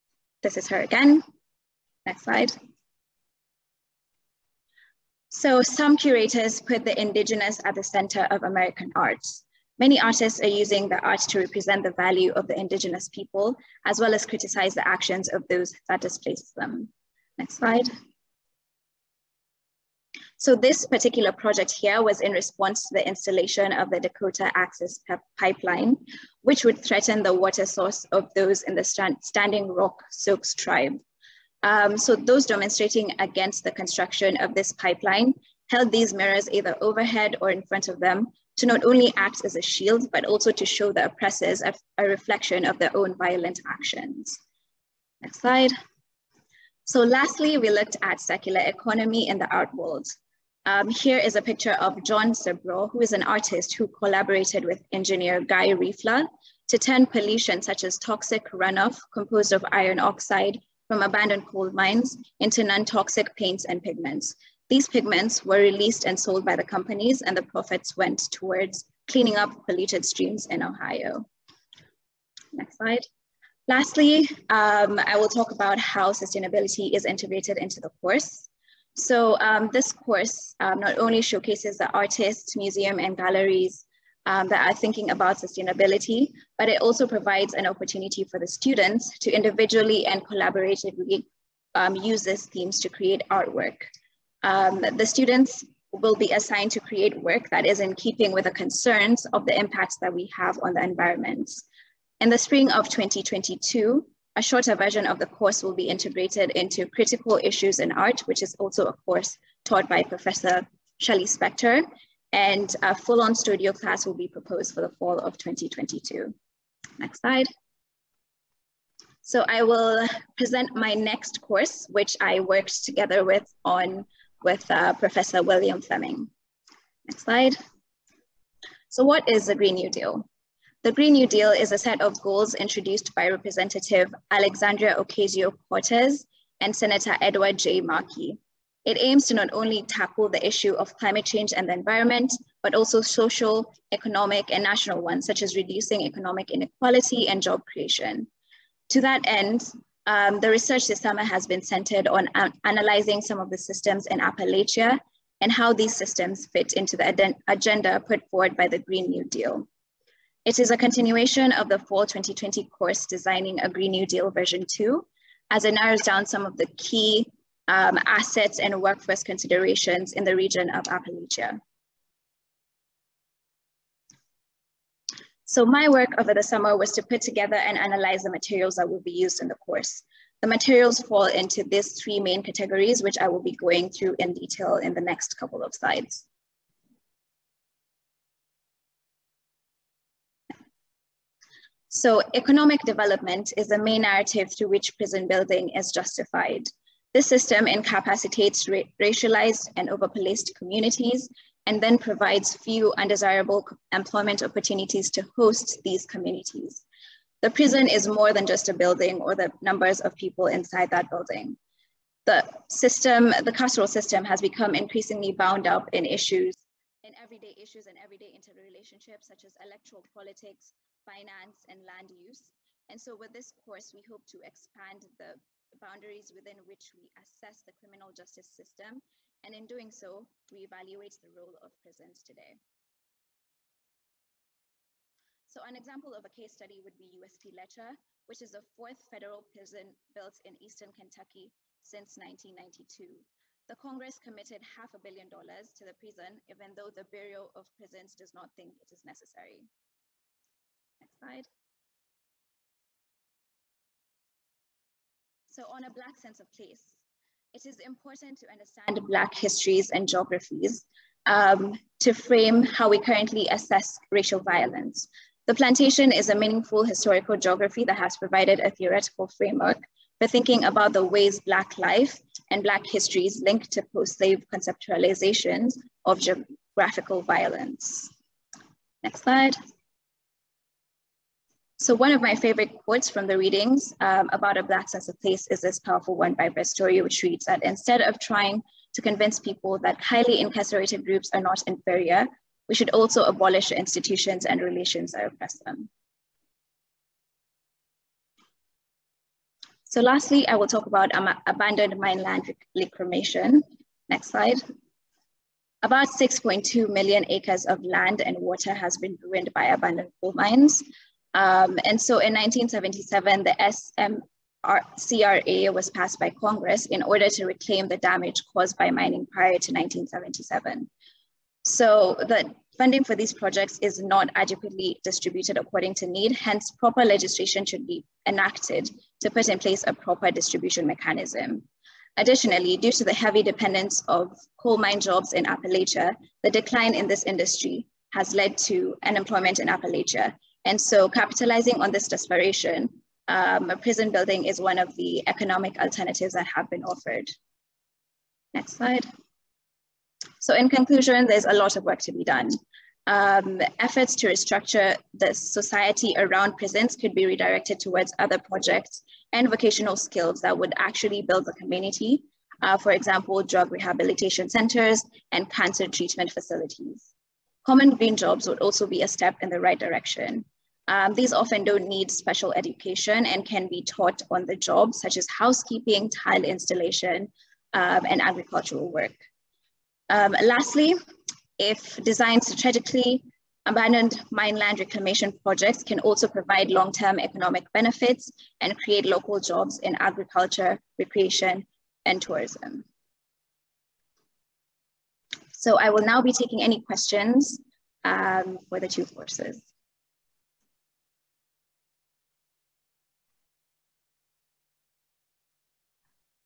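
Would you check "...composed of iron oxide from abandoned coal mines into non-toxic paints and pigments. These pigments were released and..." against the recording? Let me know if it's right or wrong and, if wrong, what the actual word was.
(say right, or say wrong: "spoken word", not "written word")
right.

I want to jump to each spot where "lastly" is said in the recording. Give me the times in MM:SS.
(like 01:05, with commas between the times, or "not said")
00:47, 01:13, 05:00, 06:20.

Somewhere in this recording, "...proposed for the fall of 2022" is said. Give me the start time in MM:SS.
01:54.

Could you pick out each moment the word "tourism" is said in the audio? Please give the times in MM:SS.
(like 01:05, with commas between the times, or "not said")
06:32.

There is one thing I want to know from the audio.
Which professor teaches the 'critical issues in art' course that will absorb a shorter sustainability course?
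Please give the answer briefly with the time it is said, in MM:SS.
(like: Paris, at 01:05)
Shelley Spector, at 01:51.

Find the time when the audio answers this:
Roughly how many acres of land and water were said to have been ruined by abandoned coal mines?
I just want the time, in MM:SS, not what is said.
05:06.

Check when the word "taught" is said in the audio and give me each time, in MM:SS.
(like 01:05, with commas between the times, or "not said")
01:49, 06:13.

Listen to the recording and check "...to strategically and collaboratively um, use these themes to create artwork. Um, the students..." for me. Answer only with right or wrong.
wrong.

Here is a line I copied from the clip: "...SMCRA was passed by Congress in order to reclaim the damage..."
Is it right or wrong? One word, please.
right.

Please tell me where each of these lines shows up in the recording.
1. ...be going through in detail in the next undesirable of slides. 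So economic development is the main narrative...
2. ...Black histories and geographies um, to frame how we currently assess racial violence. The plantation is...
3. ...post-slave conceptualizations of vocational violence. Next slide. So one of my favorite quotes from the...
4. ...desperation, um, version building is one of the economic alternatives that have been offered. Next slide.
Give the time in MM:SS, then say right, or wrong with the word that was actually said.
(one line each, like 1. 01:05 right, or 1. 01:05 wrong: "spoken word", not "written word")
1. 03:03 wrong: "couple", not "undesirable"
2. 04:19 right
3. 04:33 wrong: "geographical", not "vocational"
4. 05:42 wrong: "prison", not "version".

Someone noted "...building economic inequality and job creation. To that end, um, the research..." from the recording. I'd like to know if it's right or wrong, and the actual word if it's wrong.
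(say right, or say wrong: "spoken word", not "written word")
wrong: "reducing", not "building".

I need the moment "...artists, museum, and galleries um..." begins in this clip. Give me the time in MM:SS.
01:21.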